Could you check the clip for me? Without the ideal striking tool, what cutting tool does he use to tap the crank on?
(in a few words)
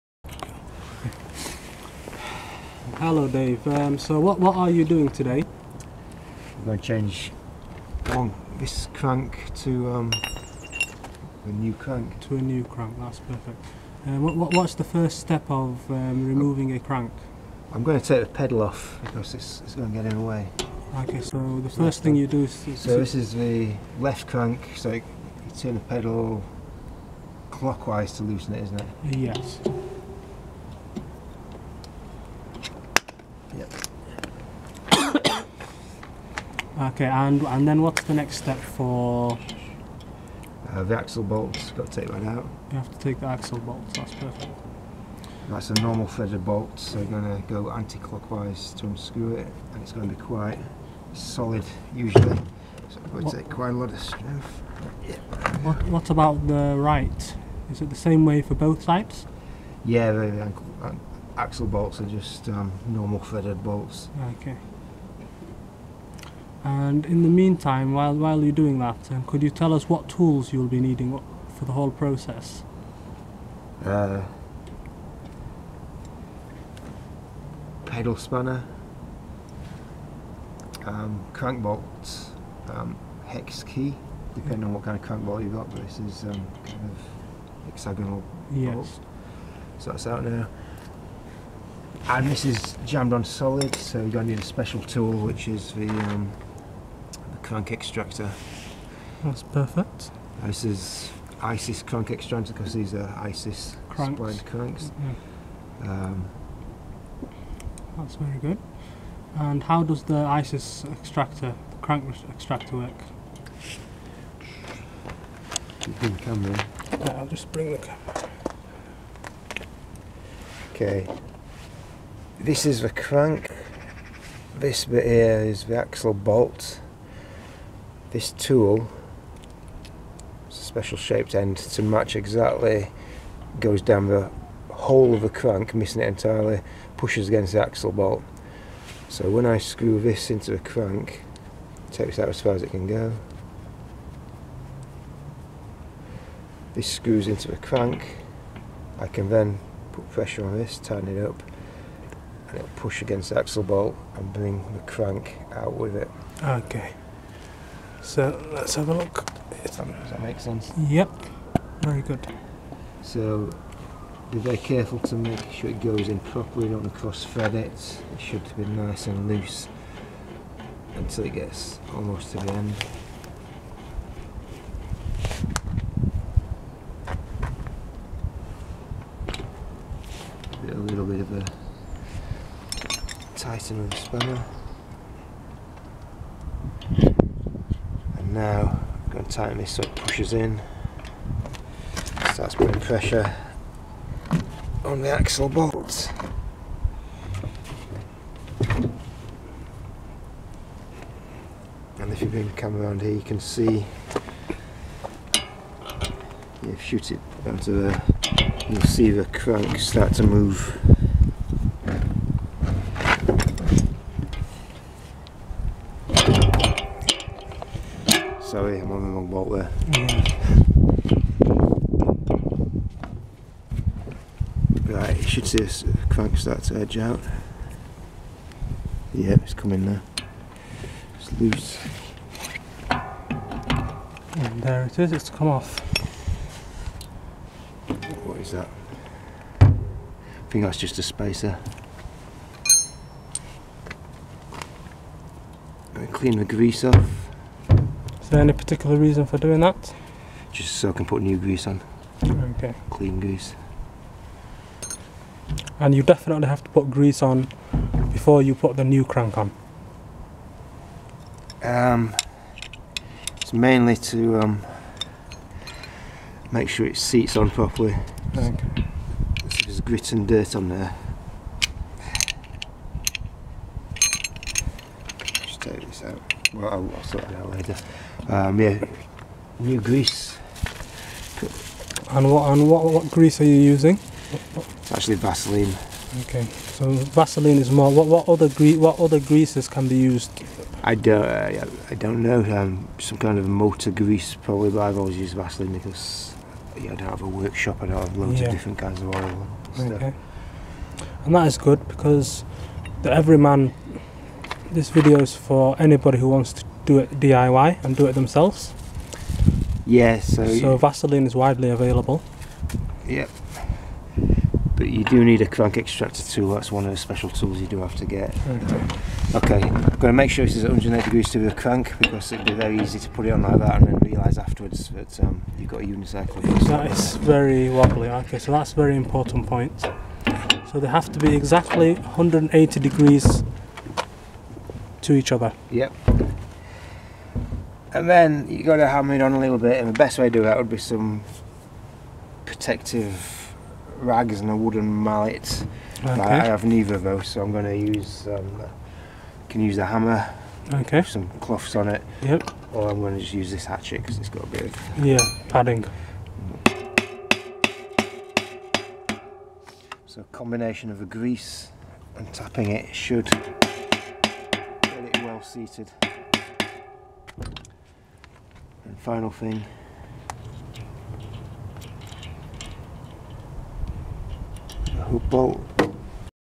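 Hatchet.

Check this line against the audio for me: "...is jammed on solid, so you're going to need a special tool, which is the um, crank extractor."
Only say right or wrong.
right.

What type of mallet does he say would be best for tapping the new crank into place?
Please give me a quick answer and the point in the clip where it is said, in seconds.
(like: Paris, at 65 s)
Wooden mallet, at 344 s.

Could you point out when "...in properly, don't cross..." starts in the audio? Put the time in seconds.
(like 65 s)
166 s.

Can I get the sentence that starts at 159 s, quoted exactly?
Does that, does that make sense?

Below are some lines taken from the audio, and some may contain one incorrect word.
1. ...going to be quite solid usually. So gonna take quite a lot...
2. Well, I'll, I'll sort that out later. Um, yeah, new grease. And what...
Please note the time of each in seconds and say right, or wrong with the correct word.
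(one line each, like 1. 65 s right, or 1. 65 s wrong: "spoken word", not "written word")
1. 49 s right
2. 276 s right.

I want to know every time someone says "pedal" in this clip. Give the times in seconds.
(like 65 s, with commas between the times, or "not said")
18 s, 25 s, 77 s.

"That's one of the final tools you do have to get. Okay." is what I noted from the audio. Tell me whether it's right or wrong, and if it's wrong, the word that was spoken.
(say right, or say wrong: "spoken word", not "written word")
wrong: "special", not "final".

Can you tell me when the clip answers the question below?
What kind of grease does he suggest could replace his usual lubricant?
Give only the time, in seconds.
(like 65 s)
293 s.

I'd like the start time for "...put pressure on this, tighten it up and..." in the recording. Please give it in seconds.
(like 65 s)
149 s.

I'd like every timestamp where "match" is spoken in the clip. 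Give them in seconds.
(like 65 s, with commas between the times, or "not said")
131 s.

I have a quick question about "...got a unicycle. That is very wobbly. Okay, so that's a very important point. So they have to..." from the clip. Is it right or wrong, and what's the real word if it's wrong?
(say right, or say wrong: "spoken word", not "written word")
right.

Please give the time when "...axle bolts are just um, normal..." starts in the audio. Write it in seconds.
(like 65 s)
61 s.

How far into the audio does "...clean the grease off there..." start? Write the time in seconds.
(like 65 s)
246 s.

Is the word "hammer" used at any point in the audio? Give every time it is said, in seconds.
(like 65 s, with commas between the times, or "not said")
338 s, 349 s.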